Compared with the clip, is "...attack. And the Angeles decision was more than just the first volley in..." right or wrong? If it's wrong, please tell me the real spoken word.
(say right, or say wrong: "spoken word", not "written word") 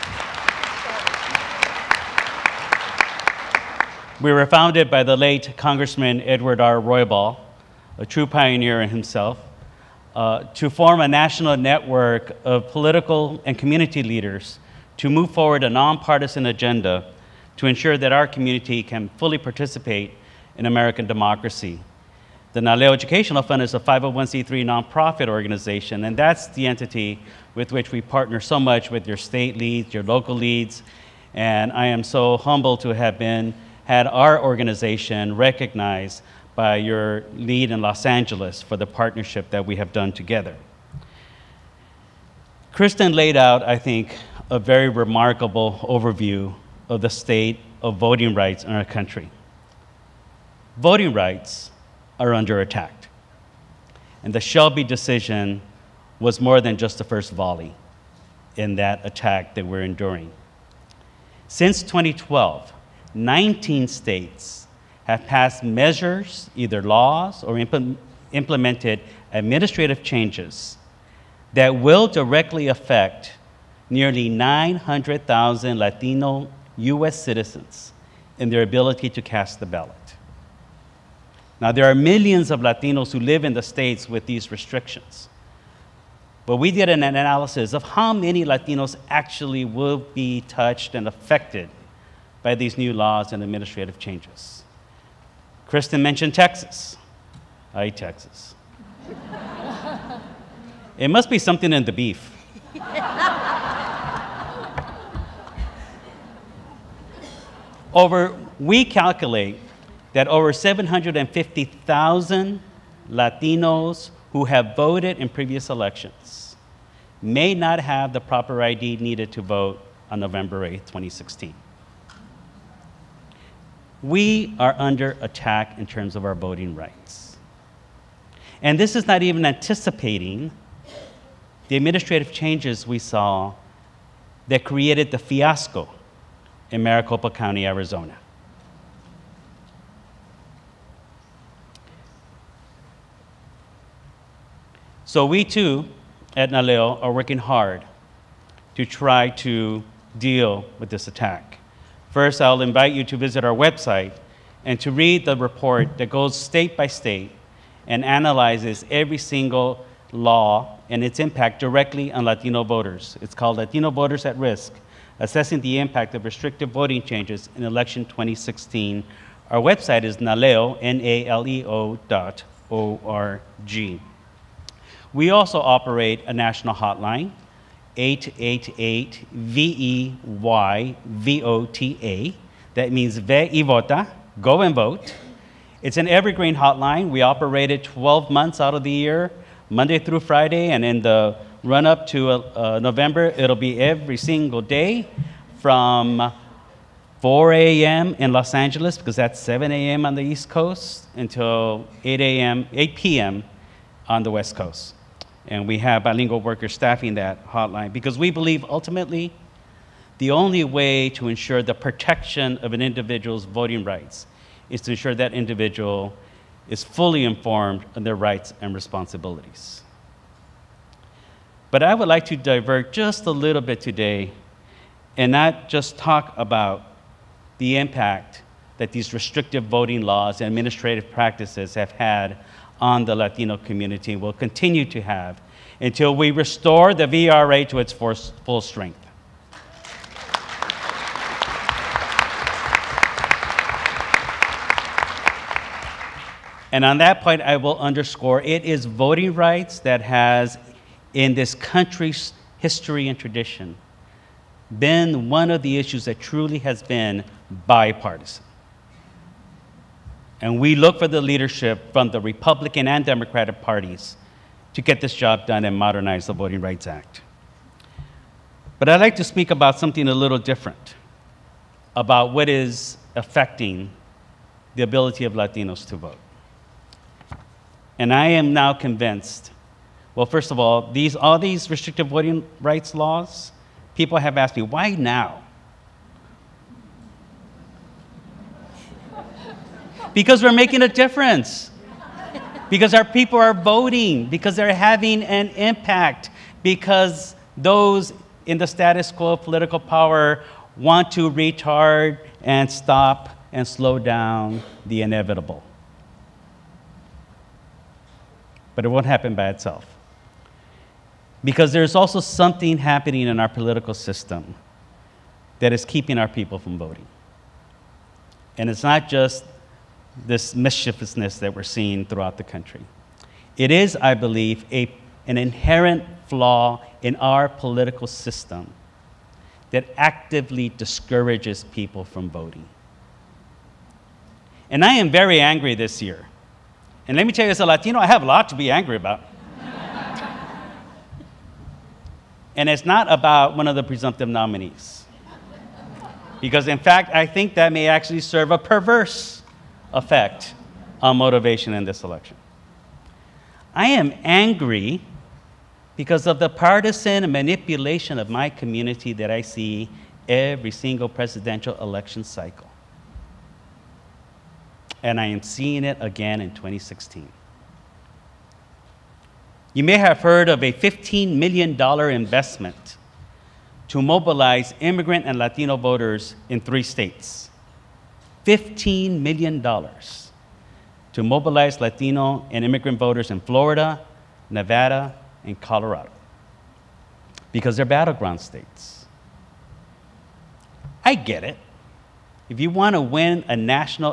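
wrong: "Shelby", not "Angeles".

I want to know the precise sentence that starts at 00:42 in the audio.
Kristen laid out, I think, a very remarkable overview of the state of voting rights in our country.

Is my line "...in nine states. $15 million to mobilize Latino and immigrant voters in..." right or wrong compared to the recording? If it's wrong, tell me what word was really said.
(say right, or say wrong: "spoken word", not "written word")
wrong: "three", not "nine".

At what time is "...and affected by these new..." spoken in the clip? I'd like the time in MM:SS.
01:30.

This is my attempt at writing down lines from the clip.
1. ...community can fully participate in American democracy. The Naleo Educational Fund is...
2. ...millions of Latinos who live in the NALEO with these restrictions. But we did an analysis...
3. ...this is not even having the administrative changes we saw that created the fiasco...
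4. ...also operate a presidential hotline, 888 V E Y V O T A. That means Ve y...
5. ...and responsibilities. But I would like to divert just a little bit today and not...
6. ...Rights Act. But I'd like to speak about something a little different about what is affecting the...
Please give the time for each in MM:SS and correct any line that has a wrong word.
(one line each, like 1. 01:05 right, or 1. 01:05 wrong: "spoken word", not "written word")
1. 00:18 right
2. 01:21 wrong: "States", not "NALEO"
3. 02:08 wrong: "anticipating", not "having"
4. 02:55 wrong: "national", not "presidential"
5. 03:38 right
6. 04:26 right.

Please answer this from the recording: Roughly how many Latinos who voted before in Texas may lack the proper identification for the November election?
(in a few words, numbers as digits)
750,000.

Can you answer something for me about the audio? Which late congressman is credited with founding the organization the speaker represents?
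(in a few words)
Edward R. Roybal.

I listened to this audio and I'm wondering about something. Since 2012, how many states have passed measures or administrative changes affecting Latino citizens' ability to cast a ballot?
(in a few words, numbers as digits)
19.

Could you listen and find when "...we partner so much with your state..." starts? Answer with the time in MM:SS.
00:27.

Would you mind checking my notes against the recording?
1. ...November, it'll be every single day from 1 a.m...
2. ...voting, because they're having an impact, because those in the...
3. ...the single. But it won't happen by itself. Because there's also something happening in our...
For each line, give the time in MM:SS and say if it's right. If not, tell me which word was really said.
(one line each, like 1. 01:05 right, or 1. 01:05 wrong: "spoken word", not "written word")
1. 03:12 wrong: "4", not "1"
2. 04:53 right
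3. 05:04 wrong: "inevitable", not "single".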